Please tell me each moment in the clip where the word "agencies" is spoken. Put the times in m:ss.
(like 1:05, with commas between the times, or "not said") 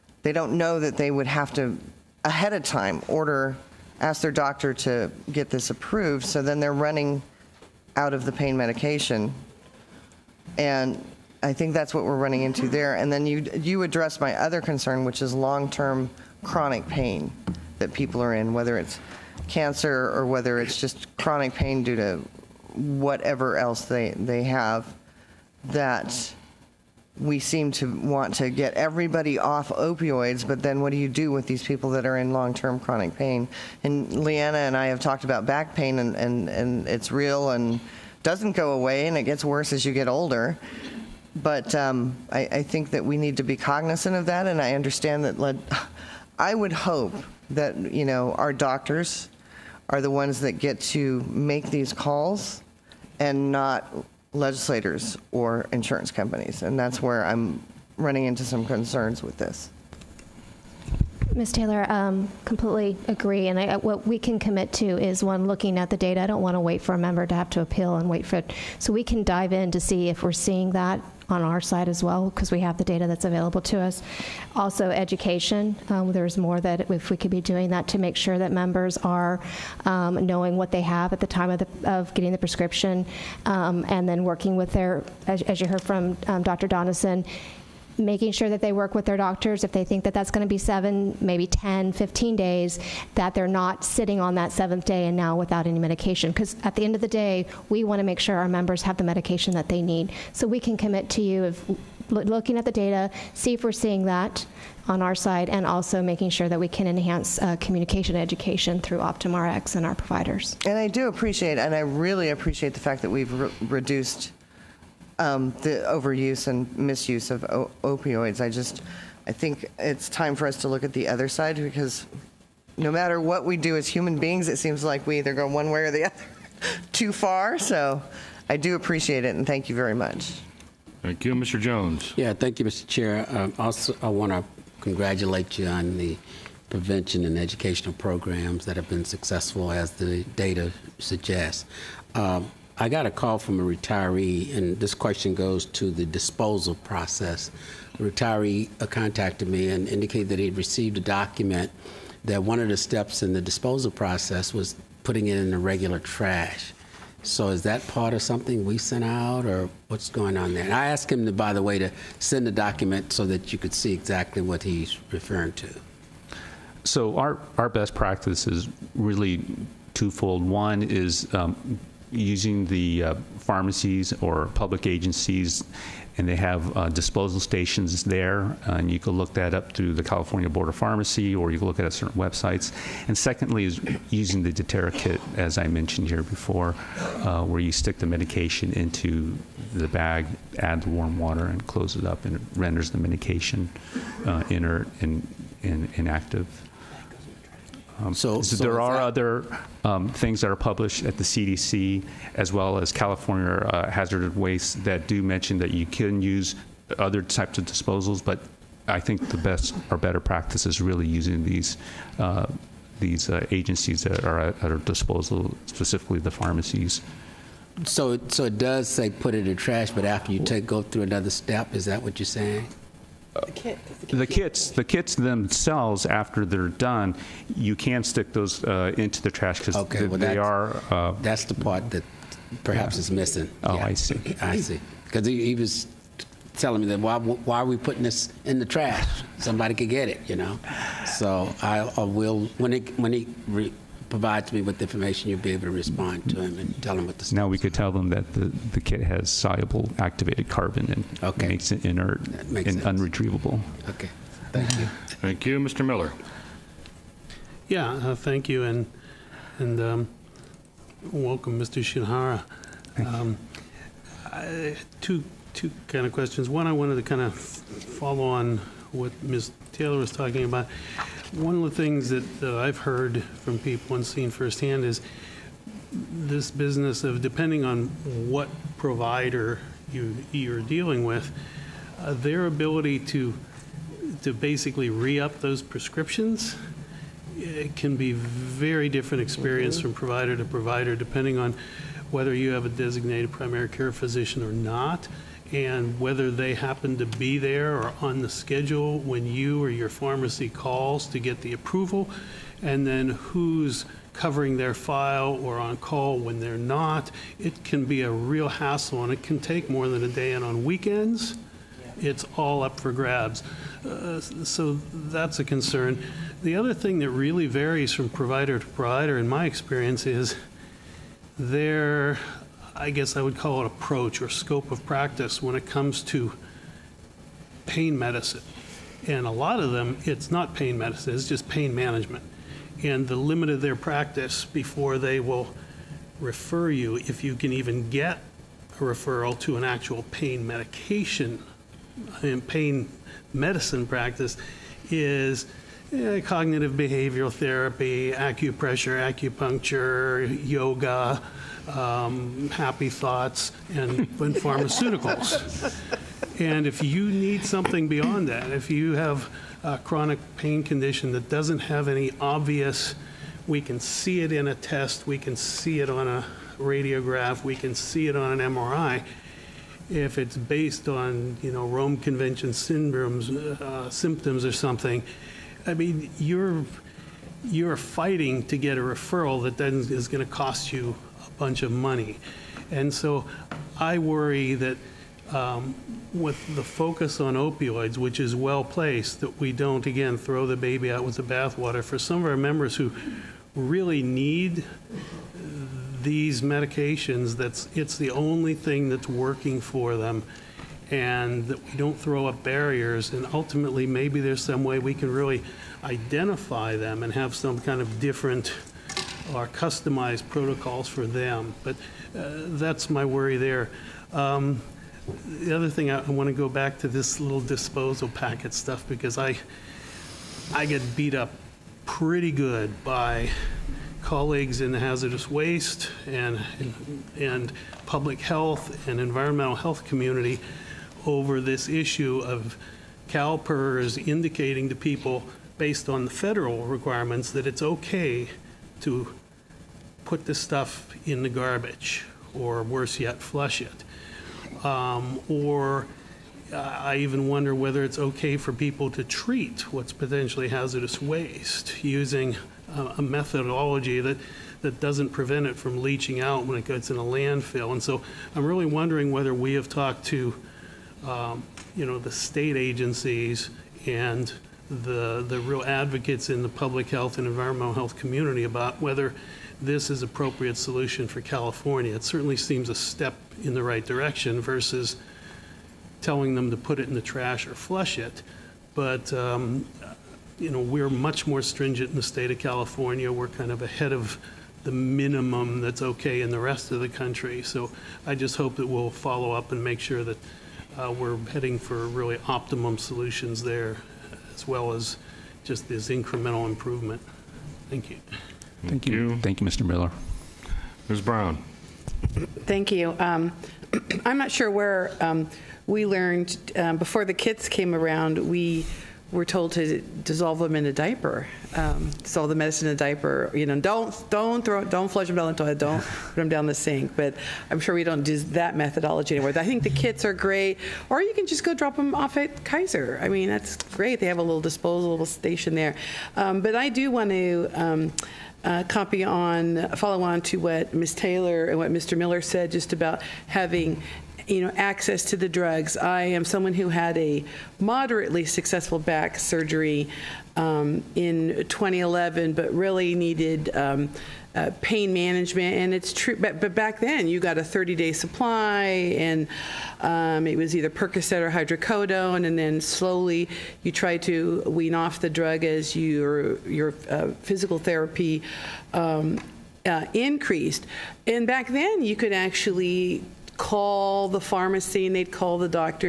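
2:54, 3:33, 7:42.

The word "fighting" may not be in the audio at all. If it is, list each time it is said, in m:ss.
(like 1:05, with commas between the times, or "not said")
6:17.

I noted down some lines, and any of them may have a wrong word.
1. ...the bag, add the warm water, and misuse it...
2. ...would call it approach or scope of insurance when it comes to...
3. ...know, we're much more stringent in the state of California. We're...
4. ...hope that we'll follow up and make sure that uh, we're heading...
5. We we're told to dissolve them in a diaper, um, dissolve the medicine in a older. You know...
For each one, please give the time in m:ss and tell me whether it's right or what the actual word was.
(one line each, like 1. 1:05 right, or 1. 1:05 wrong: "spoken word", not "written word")
1. 3:09 wrong: "close", not "misuse"
2. 5:23 wrong: "practice", not "insurance"
3. 8:00 right
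4. 8:08 right
5. 8:28 wrong: "diaper", not "older".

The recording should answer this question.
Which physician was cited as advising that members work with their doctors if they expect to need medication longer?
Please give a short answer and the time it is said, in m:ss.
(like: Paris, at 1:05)
Dr. Donneson, at 1:26.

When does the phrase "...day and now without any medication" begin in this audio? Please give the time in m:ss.
1:34.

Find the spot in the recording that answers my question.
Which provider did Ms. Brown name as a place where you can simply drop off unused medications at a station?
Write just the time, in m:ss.
8:42.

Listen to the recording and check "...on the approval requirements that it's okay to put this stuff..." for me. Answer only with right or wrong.
wrong.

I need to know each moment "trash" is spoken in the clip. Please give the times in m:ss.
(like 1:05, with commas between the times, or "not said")
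2:35, 3:39, 3:49, 3:58, 7:57.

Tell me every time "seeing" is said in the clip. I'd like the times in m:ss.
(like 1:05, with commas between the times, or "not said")
1:10, 1:43.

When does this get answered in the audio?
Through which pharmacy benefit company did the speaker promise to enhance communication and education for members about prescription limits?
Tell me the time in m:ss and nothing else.
1:48.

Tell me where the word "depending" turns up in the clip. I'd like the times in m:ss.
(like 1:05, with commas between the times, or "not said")
4:37, 4:50.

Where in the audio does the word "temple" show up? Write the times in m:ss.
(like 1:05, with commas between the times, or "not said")
not said.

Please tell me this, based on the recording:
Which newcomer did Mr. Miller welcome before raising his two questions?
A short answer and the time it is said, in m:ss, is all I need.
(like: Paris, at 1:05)
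Mr. Shinohara, at 4:21.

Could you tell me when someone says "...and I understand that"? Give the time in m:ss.
0:44.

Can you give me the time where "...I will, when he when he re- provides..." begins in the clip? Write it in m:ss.
4:01.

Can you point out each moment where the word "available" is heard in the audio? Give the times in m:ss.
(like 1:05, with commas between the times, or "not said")
1:13.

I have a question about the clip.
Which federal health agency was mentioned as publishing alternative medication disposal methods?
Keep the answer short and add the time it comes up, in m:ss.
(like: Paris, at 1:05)
CDC, at 3:21.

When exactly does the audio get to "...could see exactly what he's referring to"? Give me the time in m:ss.
2:43.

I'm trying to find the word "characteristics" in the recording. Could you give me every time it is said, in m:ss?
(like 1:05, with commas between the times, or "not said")
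not said.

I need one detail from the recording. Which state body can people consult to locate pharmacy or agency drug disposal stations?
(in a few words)
California Board of Pharmacy.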